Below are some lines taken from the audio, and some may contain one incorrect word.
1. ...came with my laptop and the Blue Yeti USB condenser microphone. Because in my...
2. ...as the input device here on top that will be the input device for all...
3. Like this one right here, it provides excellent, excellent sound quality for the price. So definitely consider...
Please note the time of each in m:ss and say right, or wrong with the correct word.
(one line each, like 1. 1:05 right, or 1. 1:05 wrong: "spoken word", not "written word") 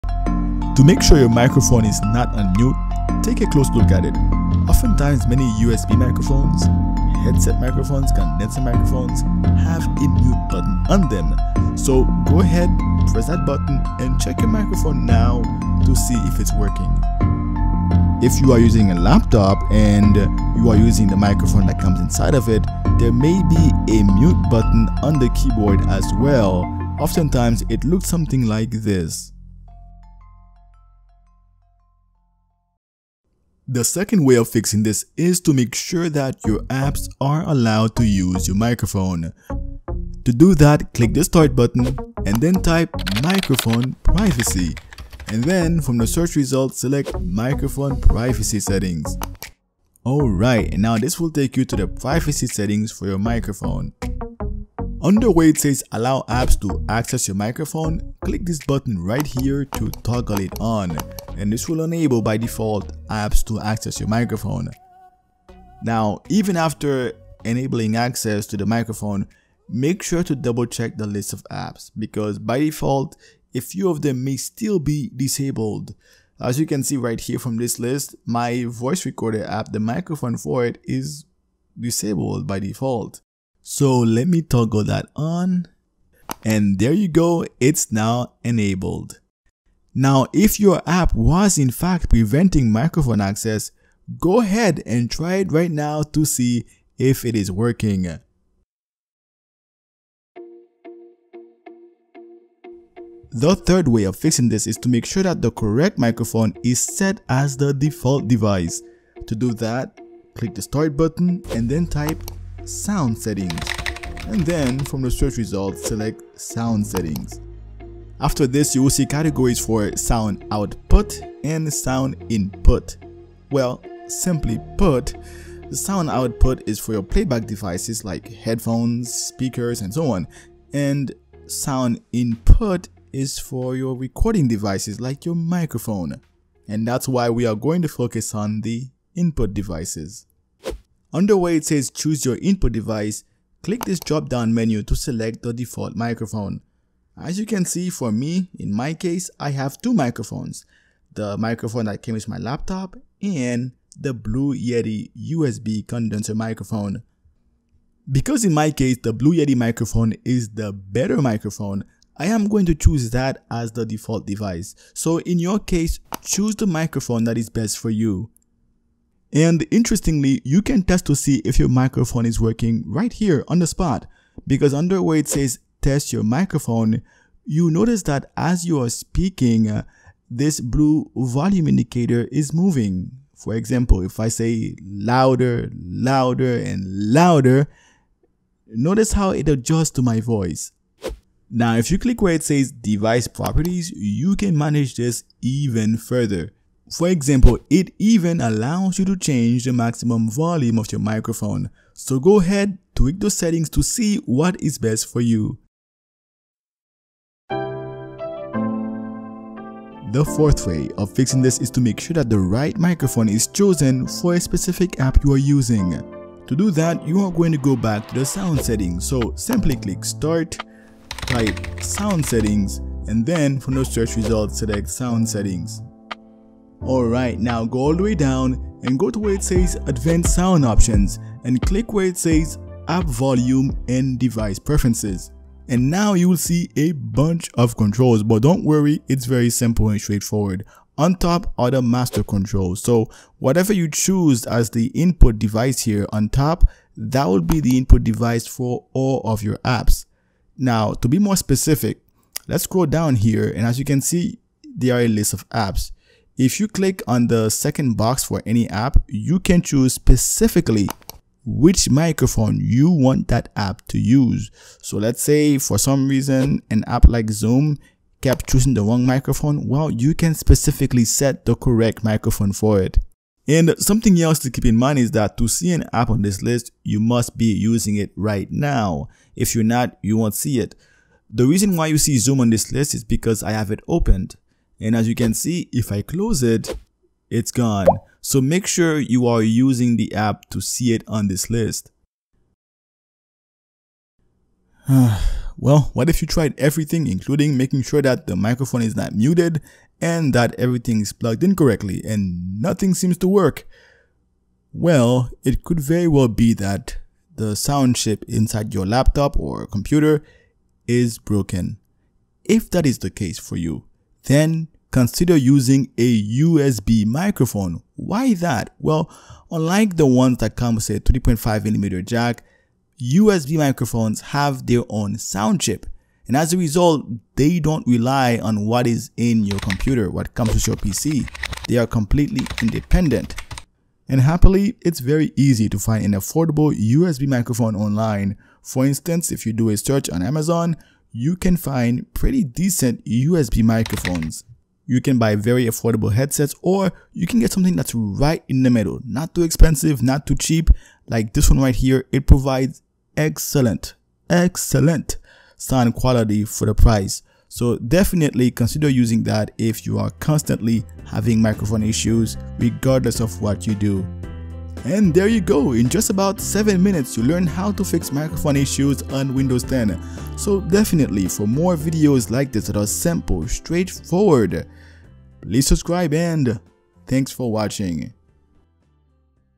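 1. 2:32 right
2. 4:04 right
3. 5:51 right.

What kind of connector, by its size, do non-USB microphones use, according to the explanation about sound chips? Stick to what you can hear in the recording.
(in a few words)
3.5 millimeter jack.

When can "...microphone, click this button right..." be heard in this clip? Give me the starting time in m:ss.
0:57.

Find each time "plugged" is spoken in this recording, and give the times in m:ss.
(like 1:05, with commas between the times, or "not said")
5:01.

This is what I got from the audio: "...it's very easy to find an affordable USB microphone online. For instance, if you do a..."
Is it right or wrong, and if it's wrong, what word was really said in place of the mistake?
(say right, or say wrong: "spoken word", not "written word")
right.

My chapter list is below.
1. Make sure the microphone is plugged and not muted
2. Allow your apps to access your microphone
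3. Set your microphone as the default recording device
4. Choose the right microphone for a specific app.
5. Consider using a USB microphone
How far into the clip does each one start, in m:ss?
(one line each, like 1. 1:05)
1. 0:16
2. 1:08
3. 2:18
4. 4:03
5. 5:30.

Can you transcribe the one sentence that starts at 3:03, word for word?
For example, if I say louder, louder, and louder, notice how it adjusts to my voice.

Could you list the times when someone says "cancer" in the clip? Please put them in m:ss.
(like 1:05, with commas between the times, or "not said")
not said.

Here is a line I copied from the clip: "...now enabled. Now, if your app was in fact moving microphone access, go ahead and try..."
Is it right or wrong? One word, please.
wrong.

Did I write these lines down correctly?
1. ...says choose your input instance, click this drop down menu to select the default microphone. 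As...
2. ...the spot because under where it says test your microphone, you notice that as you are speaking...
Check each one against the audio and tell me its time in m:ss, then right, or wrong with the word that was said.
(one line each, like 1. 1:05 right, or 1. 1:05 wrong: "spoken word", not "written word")
1. 2:21 wrong: "device", not "instance"
2. 2:53 right.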